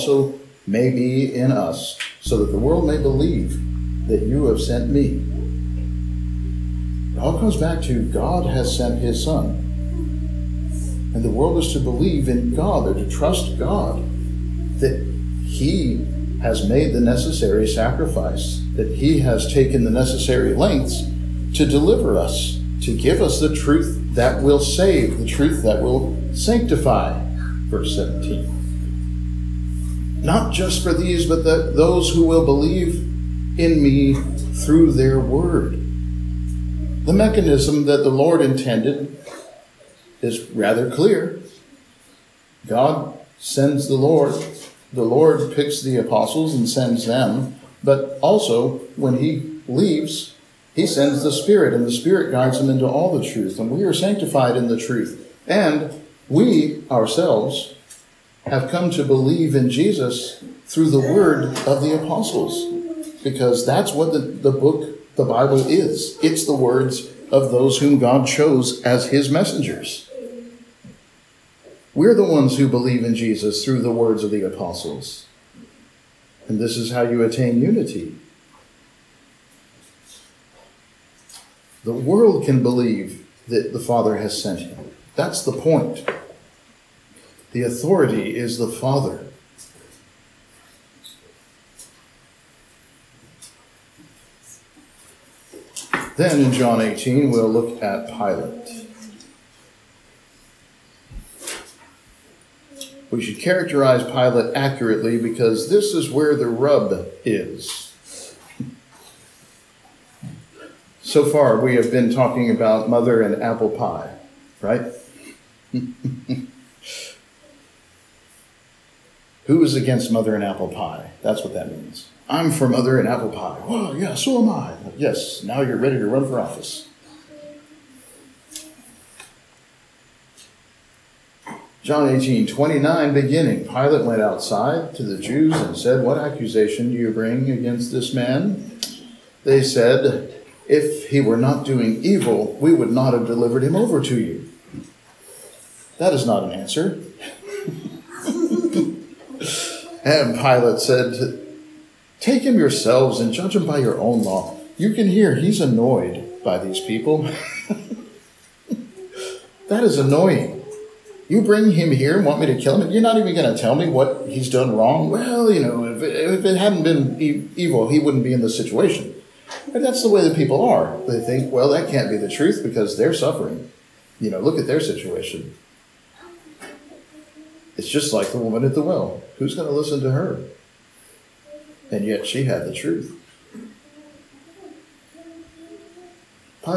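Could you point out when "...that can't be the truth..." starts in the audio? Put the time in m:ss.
2:51.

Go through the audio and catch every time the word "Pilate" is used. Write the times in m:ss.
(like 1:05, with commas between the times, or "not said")
1:38, 1:44, 2:13, 2:30.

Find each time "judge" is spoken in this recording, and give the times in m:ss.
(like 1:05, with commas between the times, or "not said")
2:33.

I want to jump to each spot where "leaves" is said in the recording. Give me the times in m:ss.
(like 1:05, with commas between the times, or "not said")
0:49.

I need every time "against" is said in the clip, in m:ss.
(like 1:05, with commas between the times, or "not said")
1:59, 2:17.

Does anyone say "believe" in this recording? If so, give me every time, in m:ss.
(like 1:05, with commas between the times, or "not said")
0:02, 0:11, 0:32, 0:59, 1:12, 1:22.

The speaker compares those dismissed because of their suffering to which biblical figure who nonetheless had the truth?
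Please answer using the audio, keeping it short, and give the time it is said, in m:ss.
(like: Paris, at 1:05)
The woman at the well, at 2:58.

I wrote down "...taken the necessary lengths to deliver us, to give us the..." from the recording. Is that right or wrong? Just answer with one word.
right.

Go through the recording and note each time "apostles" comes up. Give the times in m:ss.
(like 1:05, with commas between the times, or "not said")
0:45, 1:02, 1:14.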